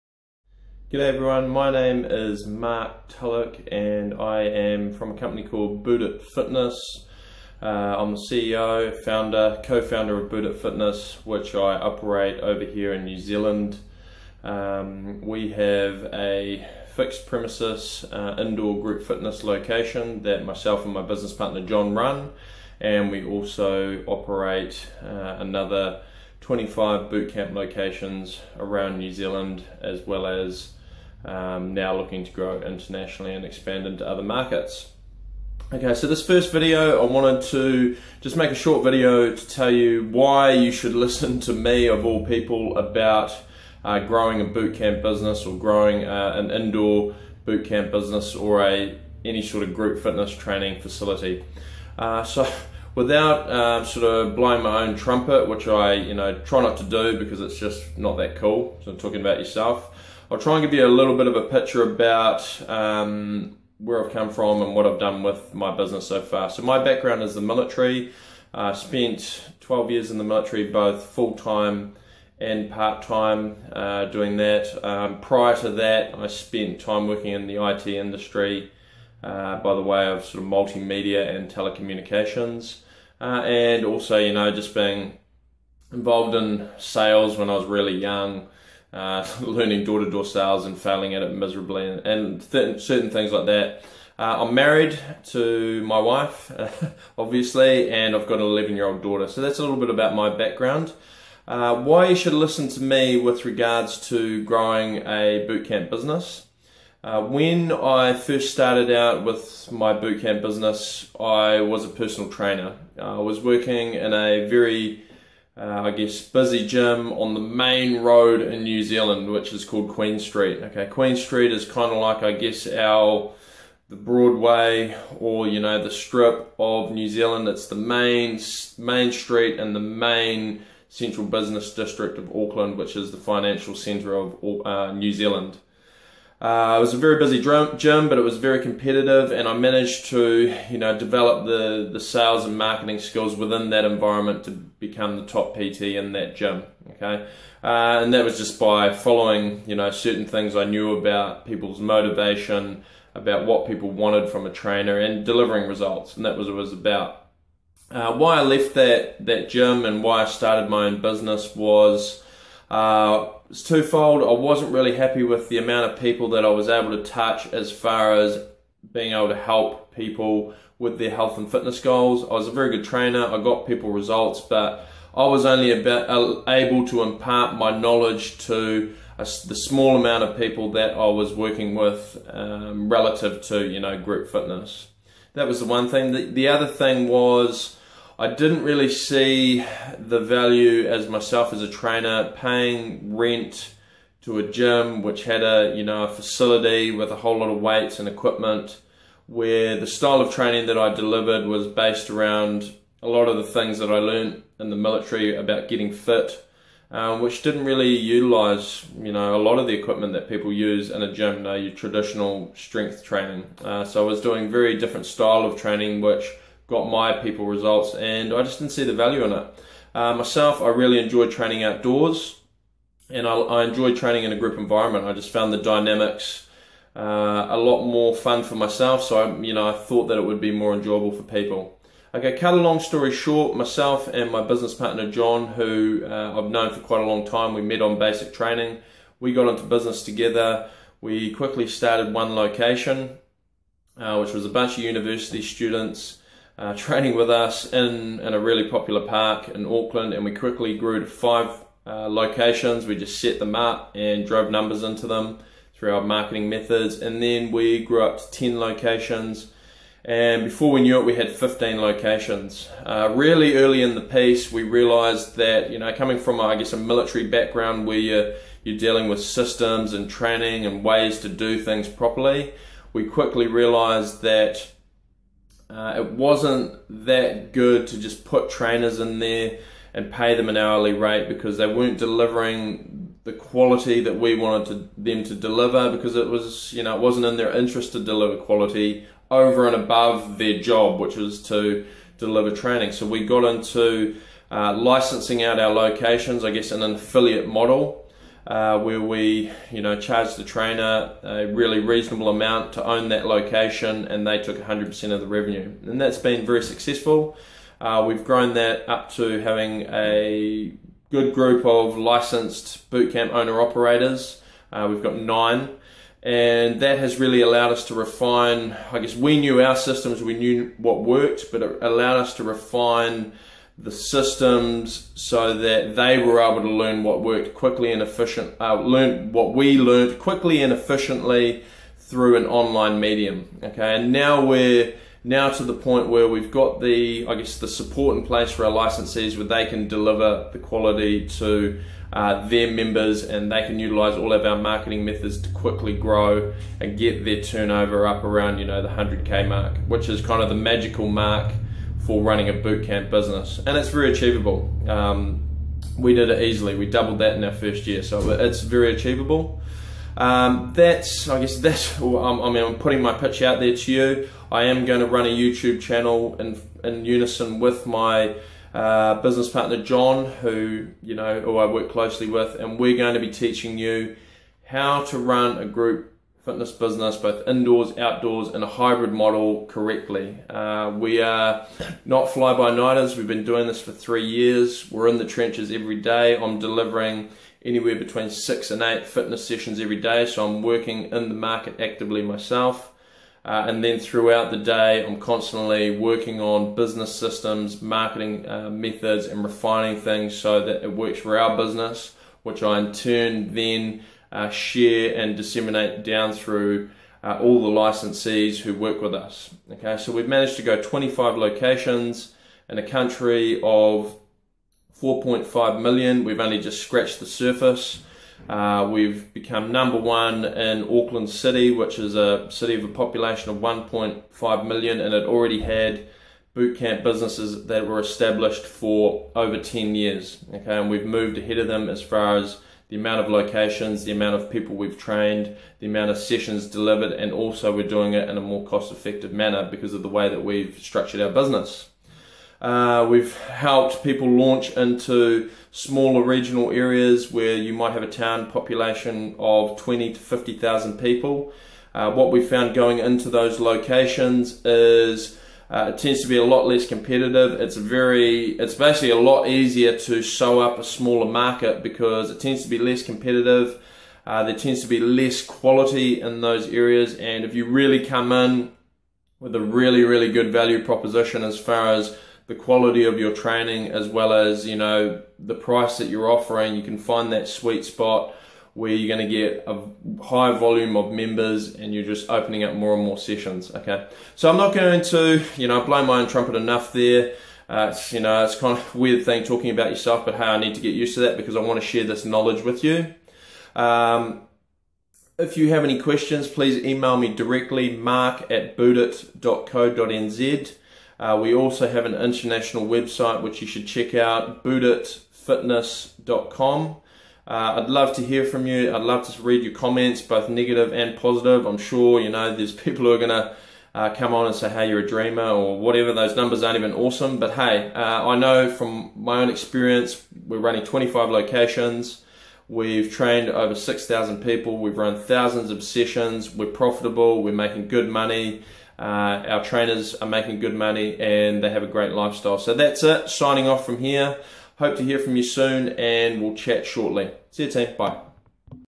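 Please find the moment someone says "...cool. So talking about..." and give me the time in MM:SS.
00:58.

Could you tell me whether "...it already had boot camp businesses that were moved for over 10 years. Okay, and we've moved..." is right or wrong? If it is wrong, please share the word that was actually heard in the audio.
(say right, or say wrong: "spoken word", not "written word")
wrong: "established", not "moved".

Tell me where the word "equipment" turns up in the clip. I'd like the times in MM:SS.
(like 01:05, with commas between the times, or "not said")
03:18, 03:29.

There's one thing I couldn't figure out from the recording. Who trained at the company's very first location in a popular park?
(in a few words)
University students.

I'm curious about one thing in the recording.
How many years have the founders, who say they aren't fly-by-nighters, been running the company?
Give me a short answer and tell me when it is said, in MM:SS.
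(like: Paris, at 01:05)
3, at 06:23.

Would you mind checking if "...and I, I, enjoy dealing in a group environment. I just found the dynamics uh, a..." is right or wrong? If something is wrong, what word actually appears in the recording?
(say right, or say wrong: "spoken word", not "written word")
wrong: "training", not "dealing".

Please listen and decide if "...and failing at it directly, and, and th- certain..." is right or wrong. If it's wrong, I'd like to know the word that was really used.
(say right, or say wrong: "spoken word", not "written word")
wrong: "miserably", not "directly".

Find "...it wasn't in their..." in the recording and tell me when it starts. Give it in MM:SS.
04:46.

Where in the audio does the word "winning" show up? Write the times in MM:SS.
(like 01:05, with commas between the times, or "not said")
not said.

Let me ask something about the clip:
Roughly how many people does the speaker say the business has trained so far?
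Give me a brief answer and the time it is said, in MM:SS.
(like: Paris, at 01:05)
6,000, at 08:43.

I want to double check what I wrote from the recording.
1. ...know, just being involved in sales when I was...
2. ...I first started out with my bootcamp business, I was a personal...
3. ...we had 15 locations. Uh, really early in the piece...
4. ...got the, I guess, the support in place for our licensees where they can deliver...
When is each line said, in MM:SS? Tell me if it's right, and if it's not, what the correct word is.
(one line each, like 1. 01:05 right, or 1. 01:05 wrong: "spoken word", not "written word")
1. 01:24 right
2. 01:47 right
3. 04:21 right
4. 05:36 right.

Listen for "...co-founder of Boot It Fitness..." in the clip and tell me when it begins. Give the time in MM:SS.
00:09.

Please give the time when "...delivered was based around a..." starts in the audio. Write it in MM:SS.
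03:20.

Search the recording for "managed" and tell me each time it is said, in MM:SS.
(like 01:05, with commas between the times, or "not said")
02:19, 06:50.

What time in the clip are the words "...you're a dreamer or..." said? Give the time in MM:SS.
08:34.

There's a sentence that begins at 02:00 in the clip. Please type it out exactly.
Okay, Queen Street is kind of like, I guess, our the Broadway or you know the Strip of New Zealand.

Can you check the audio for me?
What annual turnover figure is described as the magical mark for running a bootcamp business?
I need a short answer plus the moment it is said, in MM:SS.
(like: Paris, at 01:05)
100K, at 05:48.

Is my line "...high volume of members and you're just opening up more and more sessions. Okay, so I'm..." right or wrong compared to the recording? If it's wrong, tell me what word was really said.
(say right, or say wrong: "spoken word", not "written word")
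right.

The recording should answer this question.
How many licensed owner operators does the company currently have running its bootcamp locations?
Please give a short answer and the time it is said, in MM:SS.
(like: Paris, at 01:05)
Nine, at 05:15.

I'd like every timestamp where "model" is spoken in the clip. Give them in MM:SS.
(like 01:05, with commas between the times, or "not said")
04:57, 06:19.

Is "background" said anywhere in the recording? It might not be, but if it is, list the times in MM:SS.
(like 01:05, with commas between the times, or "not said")
01:06, 01:40, 04:27.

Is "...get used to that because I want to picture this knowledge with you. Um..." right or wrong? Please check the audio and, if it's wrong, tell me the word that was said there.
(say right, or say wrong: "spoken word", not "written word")
wrong: "share", not "picture".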